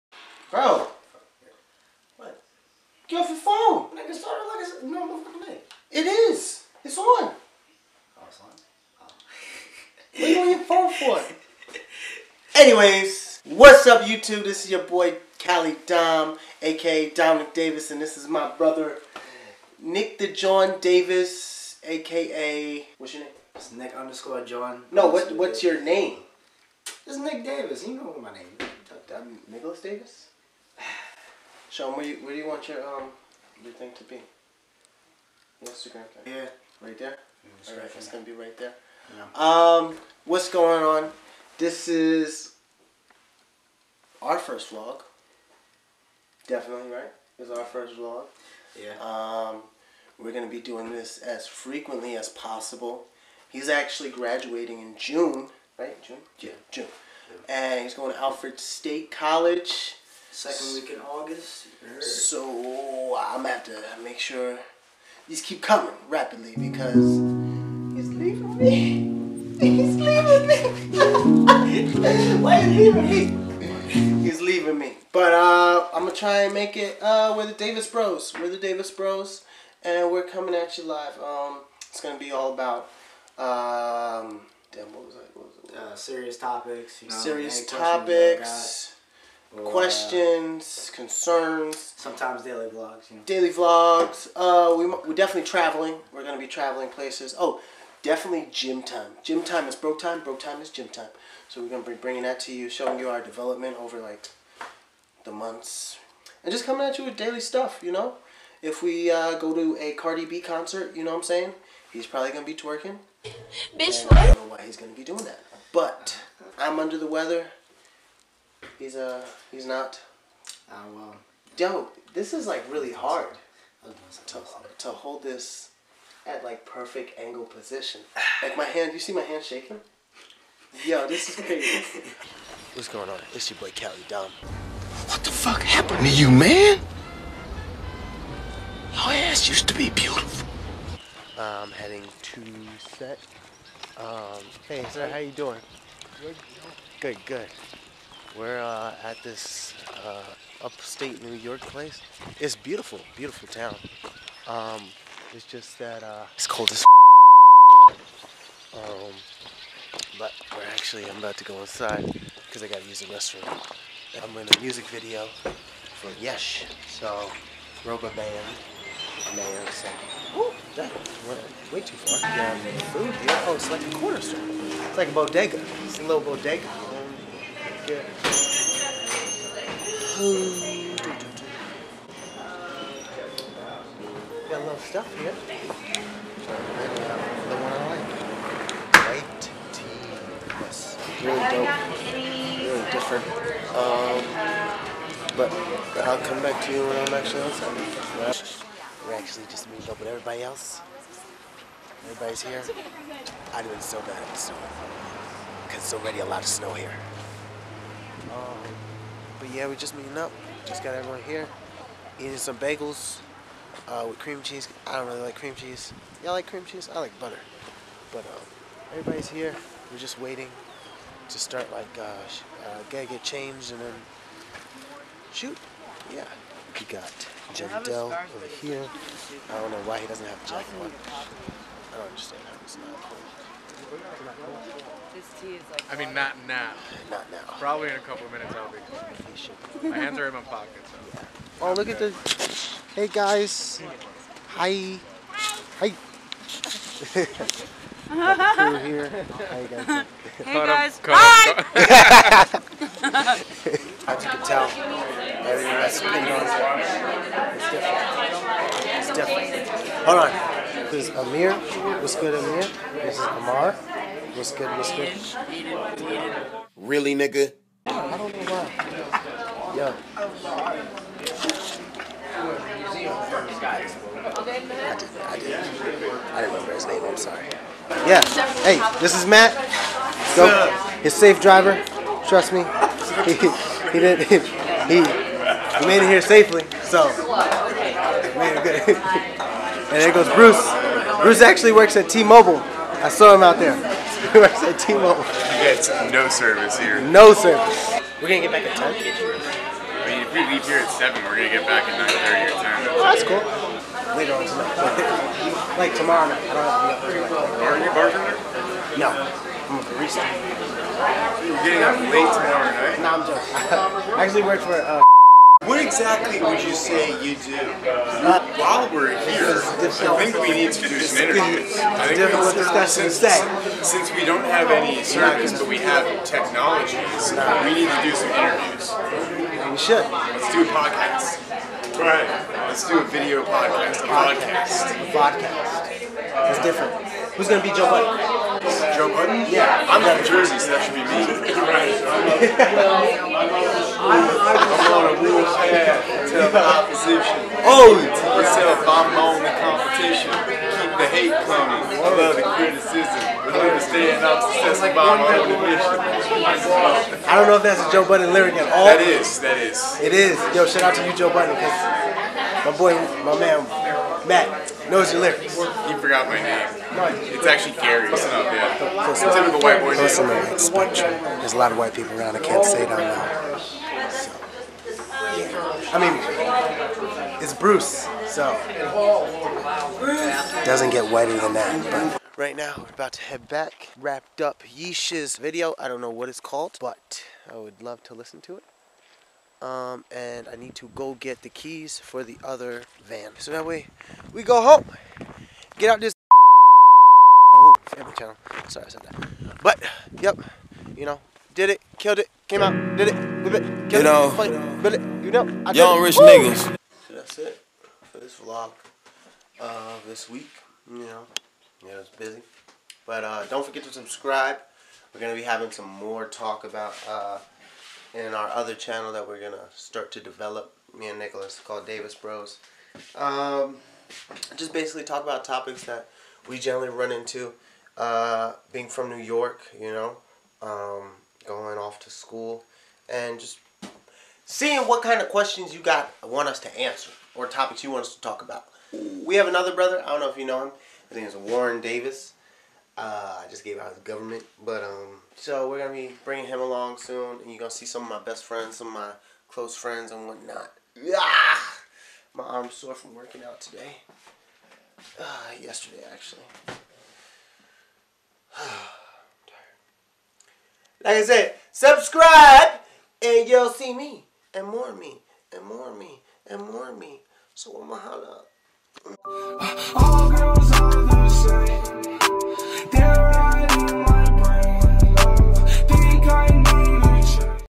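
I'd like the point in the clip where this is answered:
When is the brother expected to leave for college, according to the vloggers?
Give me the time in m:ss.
1:00.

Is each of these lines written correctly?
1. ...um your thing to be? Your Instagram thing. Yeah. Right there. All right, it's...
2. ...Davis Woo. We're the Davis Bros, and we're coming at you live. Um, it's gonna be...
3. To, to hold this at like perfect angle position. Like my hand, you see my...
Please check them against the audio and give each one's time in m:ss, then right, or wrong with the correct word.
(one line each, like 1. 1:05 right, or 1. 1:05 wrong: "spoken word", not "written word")
1. 0:32 right
2. 1:17 wrong: "Bros", not "Woo"
3. 2:04 right.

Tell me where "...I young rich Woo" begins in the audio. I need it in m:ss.
6:45.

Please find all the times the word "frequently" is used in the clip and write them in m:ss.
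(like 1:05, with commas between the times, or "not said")
0:51.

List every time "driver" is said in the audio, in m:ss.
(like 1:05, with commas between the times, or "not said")
4:41.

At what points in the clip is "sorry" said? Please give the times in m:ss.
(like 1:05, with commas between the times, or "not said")
4:37, 6:38.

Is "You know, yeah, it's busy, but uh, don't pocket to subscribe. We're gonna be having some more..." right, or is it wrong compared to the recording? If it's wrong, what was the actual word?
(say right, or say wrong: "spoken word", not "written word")
wrong: "forget", not "pocket".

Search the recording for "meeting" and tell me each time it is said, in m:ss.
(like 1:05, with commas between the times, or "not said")
3:19, 3:29.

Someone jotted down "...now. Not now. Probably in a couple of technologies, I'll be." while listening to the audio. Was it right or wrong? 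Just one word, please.
wrong.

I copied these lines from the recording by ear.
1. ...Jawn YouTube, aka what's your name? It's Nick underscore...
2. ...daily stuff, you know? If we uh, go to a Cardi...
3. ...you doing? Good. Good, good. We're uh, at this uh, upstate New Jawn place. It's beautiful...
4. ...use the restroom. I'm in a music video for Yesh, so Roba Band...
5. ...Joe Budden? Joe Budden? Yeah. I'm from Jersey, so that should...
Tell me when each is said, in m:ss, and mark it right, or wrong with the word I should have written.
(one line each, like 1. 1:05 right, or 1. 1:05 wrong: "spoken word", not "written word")
1. 0:20 wrong: "Davis", not "YouTube"
2. 1:47 right
3. 2:25 wrong: "York", not "Jawn"
4. 2:42 right
5. 5:37 right.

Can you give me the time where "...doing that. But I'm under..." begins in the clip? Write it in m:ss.
1:55.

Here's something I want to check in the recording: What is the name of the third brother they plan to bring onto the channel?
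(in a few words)
Warren Davis.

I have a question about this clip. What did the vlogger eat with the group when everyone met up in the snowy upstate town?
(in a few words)
Bagels.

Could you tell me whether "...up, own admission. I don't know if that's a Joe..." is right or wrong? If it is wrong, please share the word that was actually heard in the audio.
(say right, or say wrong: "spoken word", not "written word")
right.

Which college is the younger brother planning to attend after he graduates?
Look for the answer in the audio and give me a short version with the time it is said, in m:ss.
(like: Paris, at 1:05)
Alfred State College, at 0:58.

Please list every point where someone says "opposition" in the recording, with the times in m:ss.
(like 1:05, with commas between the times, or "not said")
5:46.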